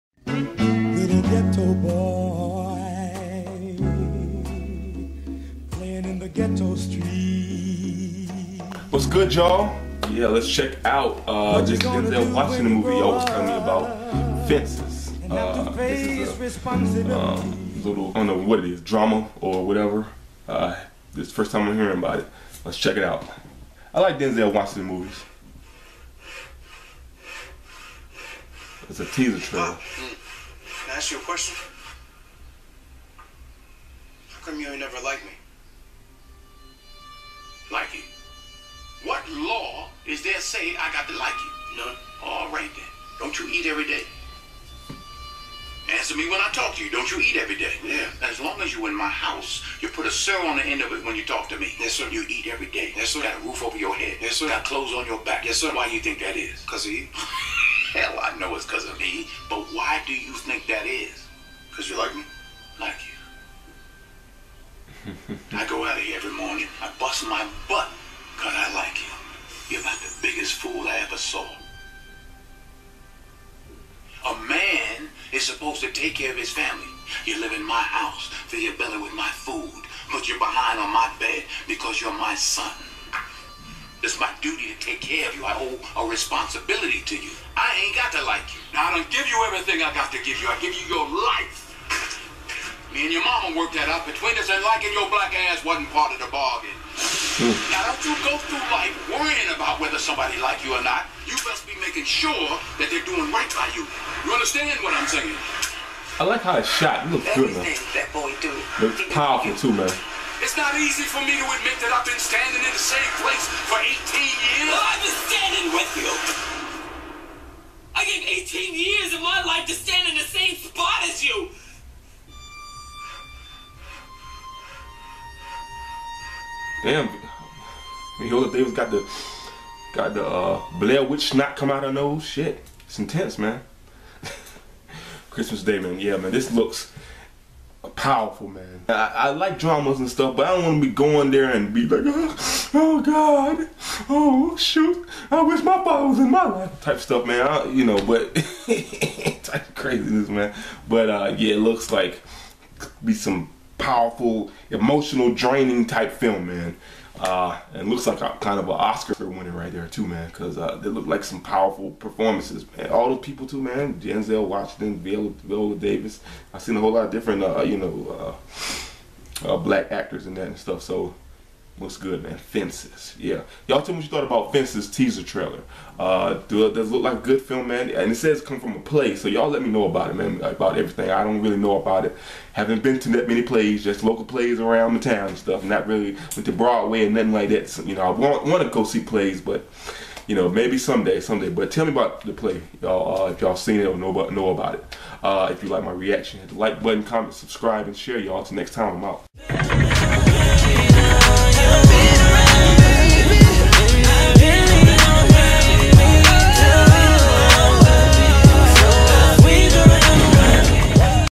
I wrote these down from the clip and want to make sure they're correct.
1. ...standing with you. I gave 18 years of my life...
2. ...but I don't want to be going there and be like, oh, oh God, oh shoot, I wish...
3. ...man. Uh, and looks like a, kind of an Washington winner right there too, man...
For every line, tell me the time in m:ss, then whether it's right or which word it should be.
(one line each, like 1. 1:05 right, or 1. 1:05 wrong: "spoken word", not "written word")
1. 1:55 right
2. 2:20 right
3. 2:36 wrong: "Oscar", not "Washington".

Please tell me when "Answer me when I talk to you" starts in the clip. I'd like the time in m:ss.
0:45.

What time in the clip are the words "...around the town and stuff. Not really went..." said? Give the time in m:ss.
3:04.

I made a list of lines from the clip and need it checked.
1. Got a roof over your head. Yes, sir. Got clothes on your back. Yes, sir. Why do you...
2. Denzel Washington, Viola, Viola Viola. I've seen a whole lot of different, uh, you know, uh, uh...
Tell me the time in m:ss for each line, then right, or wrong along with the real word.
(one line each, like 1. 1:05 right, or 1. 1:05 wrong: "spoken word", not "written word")
1. 0:53 right
2. 2:43 wrong: "Davis", not "Viola".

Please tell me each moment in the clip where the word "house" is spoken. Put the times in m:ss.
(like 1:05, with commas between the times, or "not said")
0:49, 1:17.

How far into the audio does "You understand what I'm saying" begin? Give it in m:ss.
1:44.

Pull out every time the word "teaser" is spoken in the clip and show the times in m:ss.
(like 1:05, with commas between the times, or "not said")
0:29, 2:54.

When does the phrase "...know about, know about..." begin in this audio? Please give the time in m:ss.
3:13.